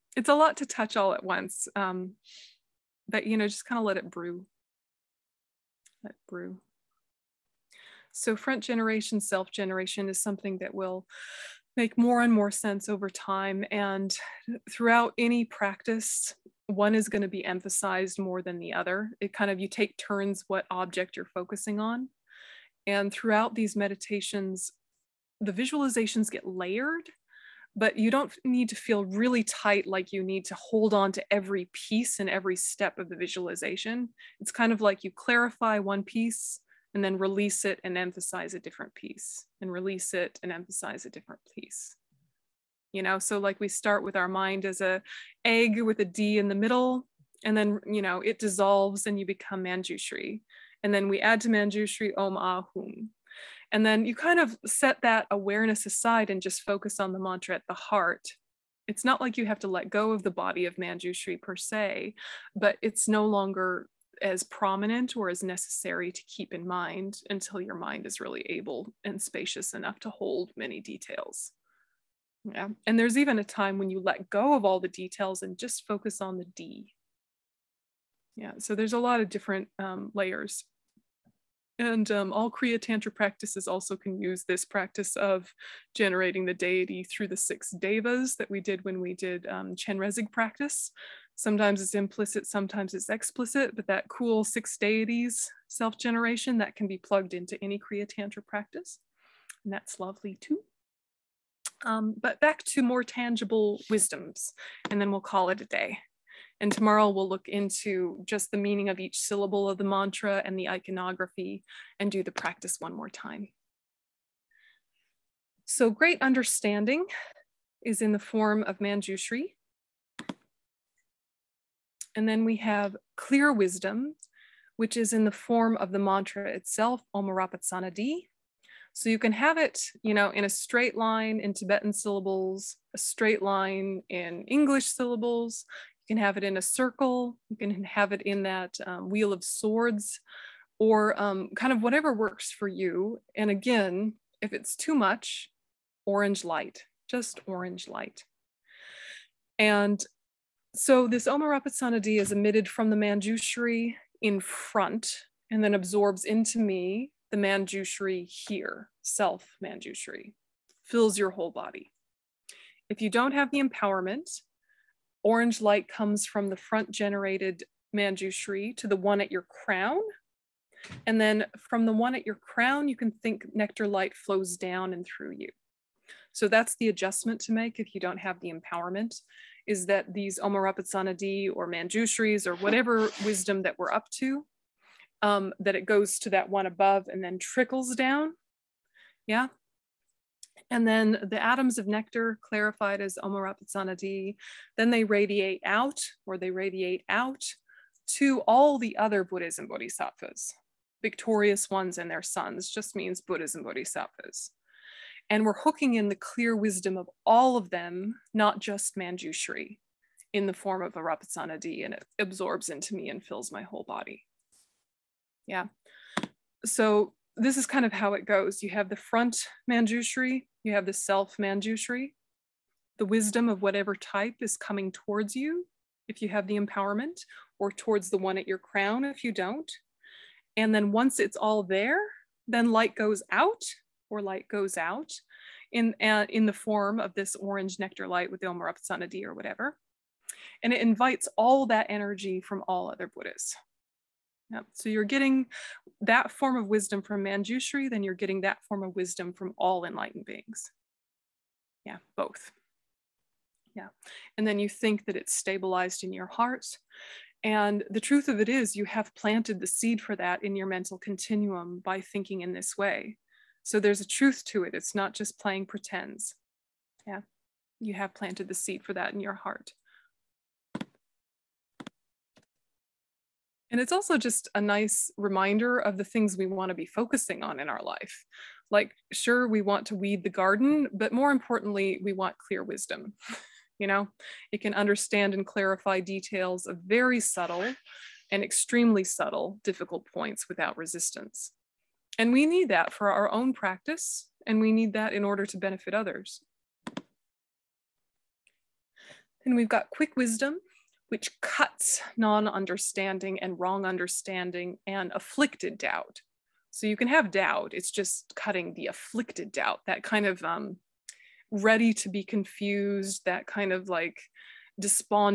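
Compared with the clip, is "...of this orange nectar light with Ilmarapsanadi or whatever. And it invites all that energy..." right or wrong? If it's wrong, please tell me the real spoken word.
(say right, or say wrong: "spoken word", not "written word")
right.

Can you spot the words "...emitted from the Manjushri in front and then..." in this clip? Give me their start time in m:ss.
2:32.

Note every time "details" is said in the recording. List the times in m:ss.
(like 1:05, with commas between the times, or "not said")
1:10, 1:14, 4:45.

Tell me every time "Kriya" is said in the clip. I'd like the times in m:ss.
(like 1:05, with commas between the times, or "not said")
1:22, 1:37.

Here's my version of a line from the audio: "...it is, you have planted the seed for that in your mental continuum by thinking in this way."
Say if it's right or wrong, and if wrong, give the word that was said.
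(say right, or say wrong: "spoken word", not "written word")
right.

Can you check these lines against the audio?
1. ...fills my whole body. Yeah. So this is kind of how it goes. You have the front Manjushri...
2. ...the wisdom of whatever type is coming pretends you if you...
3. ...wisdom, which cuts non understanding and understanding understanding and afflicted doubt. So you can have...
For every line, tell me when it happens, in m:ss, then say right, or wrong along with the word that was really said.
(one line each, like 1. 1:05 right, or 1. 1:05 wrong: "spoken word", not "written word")
1. 3:33 right
2. 3:42 wrong: "towards", not "pretends"
3. 5:00 wrong: "wrong", not "understanding".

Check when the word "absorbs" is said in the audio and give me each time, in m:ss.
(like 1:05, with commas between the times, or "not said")
2:35, 3:32.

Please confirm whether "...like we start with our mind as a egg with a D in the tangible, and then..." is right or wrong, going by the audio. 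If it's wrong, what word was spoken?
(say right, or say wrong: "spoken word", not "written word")
wrong: "middle", not "tangible".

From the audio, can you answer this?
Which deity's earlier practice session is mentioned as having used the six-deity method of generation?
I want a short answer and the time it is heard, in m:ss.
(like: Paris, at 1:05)
Chenrezig, at 1:29.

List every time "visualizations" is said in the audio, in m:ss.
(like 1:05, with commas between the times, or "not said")
0:25, 0:33.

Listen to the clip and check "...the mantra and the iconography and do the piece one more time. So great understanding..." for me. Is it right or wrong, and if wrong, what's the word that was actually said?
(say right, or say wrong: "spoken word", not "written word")
wrong: "practice", not "piece".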